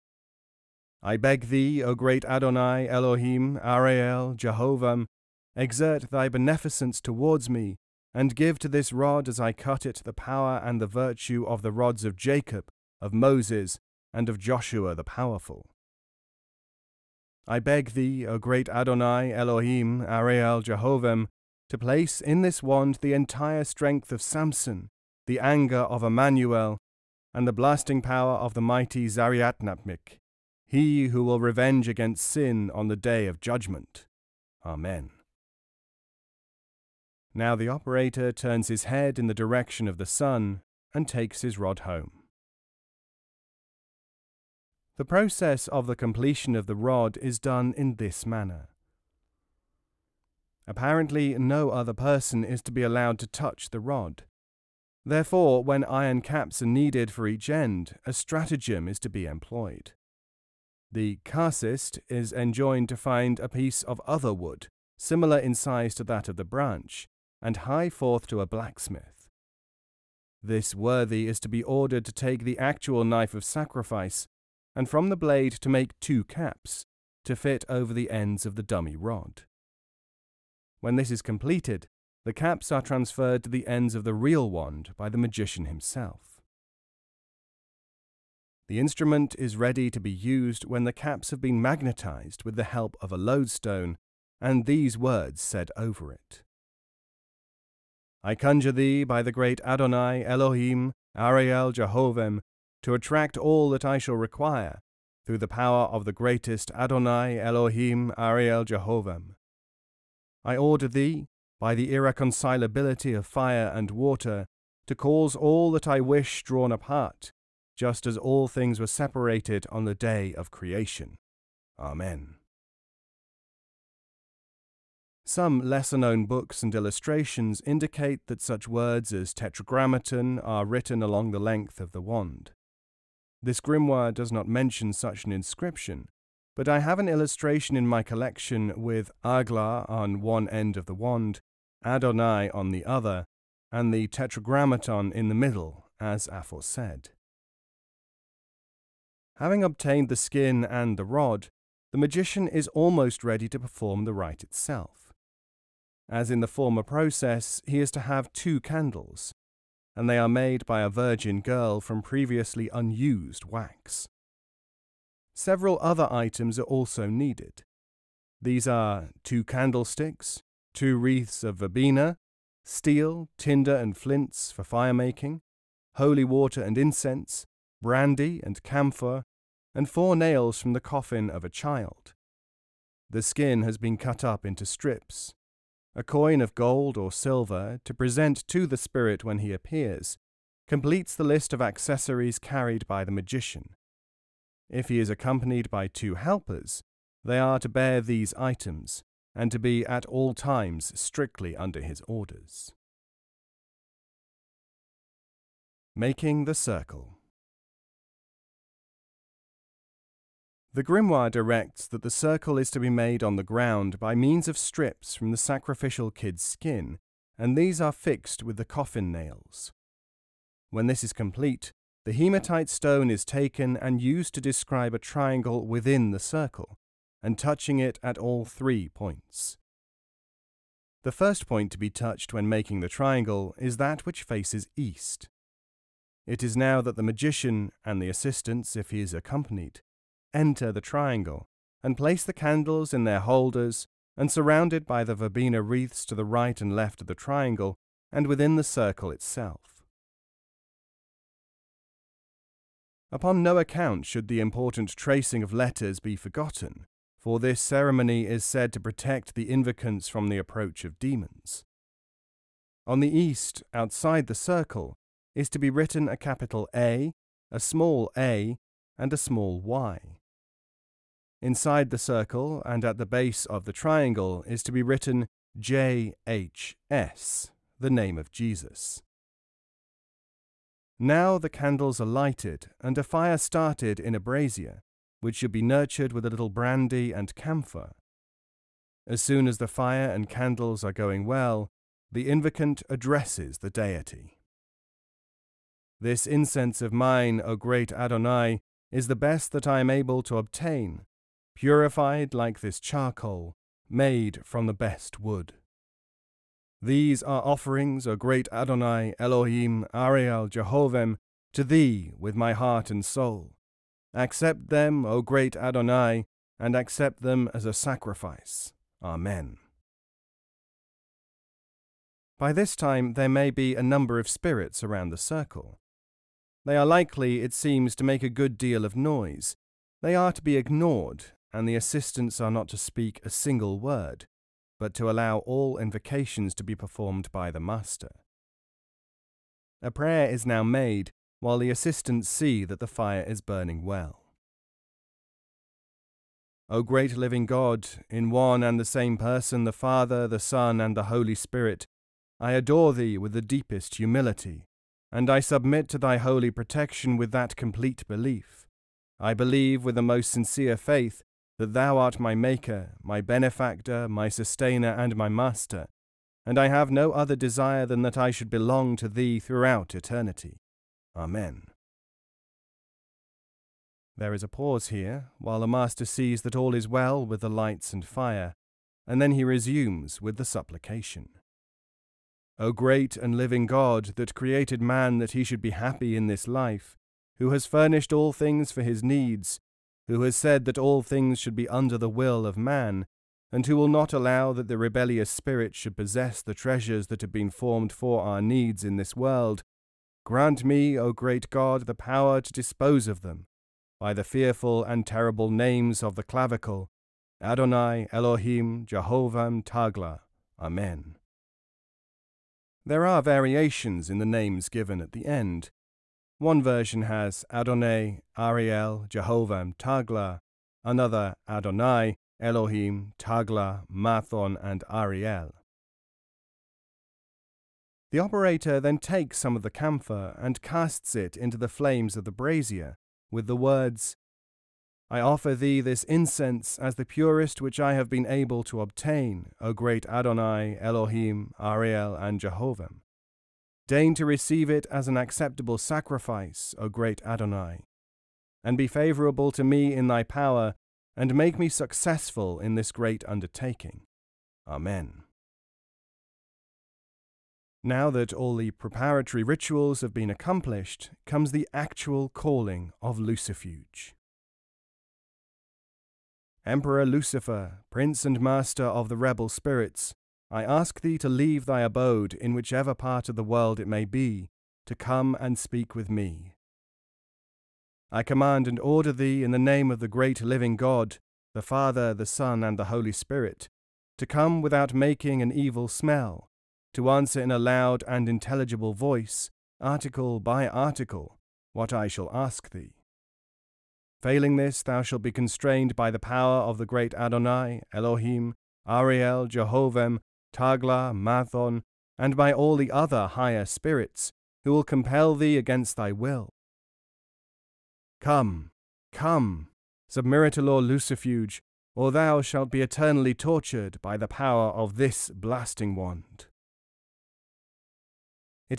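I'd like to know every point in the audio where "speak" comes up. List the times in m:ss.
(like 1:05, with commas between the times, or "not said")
5:32, 7:55.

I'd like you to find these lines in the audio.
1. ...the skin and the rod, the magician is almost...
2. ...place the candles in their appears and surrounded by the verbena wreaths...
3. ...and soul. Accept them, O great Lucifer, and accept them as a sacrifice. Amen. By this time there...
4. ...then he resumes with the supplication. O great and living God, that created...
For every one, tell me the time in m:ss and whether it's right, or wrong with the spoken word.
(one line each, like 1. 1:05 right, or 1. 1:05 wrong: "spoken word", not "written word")
1. 2:30 right
2. 4:01 wrong: "holders", not "appears"
3. 5:12 wrong: "Adonai", not "Lucifer"
4. 6:19 right.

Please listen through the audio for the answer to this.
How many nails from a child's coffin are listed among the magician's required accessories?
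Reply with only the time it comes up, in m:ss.
2:59.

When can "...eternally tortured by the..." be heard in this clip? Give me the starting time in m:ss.
8:32.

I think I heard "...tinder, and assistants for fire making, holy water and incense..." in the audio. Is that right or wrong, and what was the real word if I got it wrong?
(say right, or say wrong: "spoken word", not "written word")
wrong: "flints", not "assistants".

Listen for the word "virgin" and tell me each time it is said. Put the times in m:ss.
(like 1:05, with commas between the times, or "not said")
2:40.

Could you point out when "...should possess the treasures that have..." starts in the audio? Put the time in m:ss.
6:35.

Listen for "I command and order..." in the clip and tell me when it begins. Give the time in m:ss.
7:58.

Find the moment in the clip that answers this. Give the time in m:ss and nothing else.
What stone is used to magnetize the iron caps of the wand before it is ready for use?
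1:33.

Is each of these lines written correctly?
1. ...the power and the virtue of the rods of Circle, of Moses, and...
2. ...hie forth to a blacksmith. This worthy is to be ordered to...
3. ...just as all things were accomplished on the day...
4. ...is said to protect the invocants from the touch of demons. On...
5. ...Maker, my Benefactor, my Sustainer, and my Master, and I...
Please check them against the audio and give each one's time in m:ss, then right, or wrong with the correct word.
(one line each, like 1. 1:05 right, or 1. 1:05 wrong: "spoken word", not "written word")
1. 0:10 wrong: "Jacob", not "Circle"
2. 1:07 right
3. 1:57 wrong: "separated", not "accomplished"
4. 4:18 wrong: "approach", not "touch"
5. 6:02 right.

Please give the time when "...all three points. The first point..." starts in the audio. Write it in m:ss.
3:48.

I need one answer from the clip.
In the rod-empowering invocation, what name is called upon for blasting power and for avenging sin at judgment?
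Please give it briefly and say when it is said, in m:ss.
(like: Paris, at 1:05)
Zariatnapmik, at 0:29.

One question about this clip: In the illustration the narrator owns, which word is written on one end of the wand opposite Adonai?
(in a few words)
Agla.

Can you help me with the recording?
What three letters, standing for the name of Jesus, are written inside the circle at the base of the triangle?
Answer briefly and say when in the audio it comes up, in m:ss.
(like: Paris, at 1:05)
JHS, at 4:35.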